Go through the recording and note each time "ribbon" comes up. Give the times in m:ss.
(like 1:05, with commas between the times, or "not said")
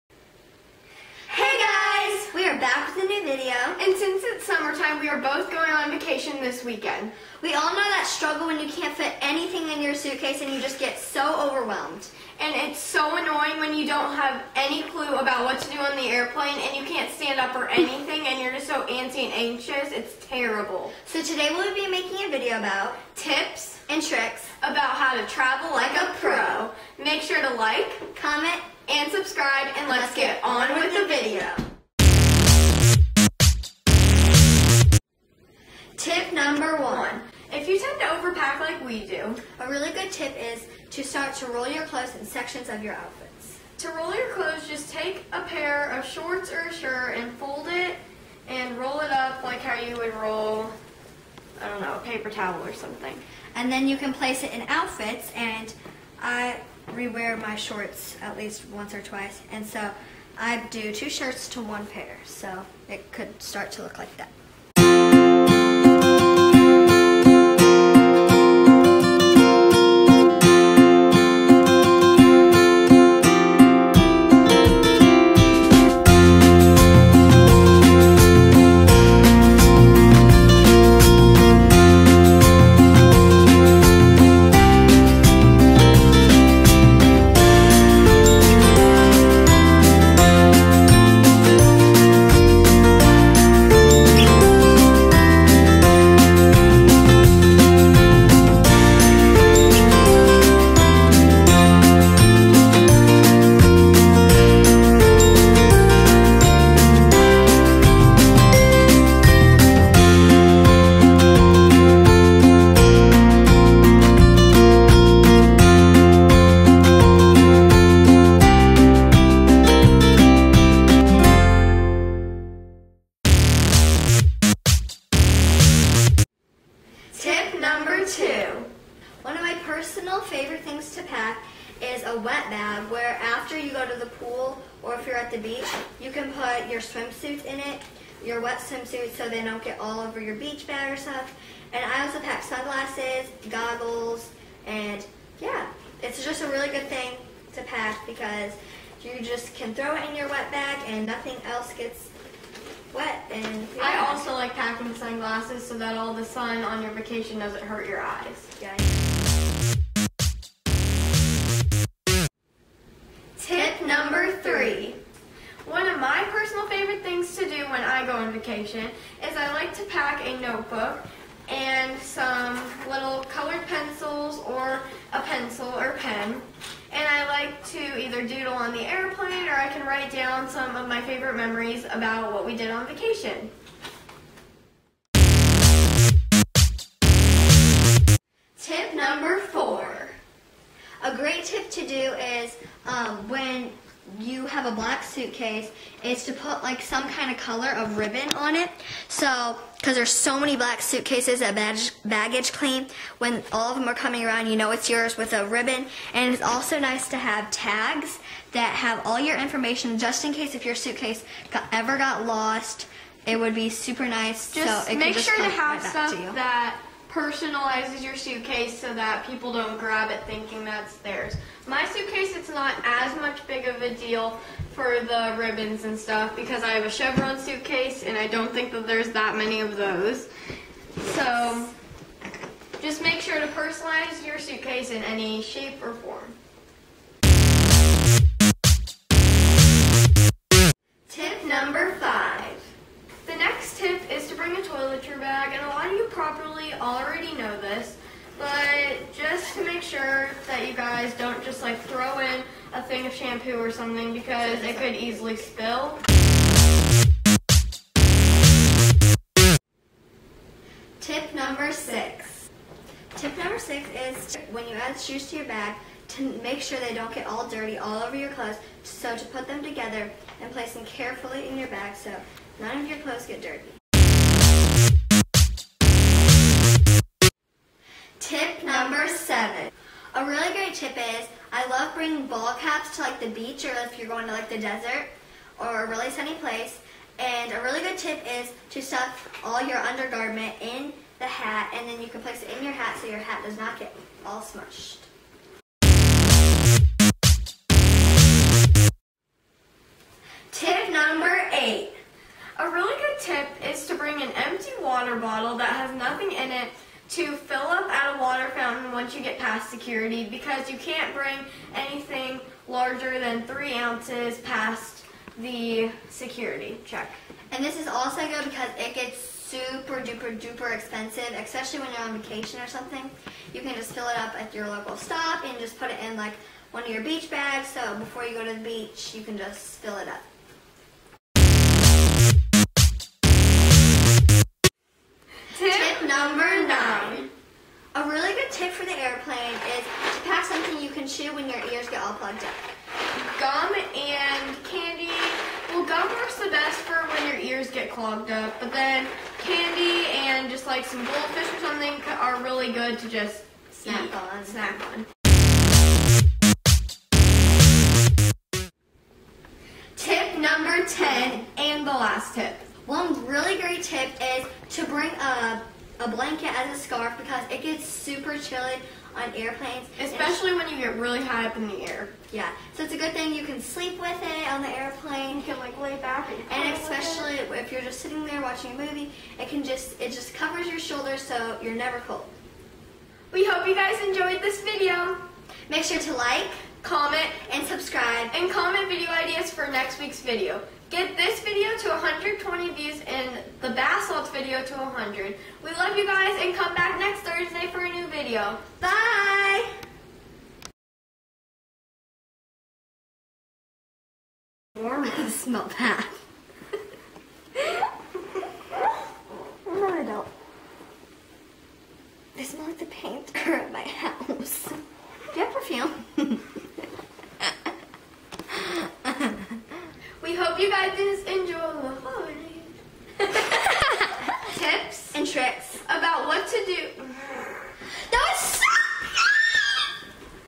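3:17, 3:25, 3:45.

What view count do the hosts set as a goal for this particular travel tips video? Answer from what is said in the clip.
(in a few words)
120.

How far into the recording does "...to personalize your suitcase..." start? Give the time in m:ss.
3:53.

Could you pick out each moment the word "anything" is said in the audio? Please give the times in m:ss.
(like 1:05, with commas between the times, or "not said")
0:09, 0:17, 5:11.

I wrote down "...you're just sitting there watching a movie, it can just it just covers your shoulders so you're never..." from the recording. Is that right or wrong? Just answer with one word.
right.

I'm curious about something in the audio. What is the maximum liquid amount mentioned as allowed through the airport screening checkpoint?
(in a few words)
3 ounces.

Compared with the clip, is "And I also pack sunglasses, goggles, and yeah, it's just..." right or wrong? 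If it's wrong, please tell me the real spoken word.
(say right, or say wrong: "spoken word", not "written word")
right.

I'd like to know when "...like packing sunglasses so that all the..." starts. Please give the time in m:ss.
2:34.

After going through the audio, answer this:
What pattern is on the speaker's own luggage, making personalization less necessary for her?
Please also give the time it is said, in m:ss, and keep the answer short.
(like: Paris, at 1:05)
Chevron, at 3:46.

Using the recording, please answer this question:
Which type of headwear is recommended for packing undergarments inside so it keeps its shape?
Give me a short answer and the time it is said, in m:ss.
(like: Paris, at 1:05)
ball caps, at 4:42.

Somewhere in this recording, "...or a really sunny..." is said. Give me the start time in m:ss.
4:45.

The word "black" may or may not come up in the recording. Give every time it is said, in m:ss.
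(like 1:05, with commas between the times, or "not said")
3:14, 3:20.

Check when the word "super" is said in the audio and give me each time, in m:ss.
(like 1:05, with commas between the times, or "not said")
3:33, 5:19, 6:07.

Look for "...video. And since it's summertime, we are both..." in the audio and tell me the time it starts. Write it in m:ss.
0:03.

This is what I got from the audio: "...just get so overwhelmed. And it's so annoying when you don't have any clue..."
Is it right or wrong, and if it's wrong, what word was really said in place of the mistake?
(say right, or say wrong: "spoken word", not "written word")
right.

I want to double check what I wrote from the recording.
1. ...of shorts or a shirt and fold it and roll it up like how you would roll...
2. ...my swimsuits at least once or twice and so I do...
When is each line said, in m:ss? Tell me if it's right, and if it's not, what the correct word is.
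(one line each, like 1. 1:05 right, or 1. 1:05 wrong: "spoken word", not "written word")
1. 0:45 right
2. 0:57 wrong: "shorts", not "swimsuits".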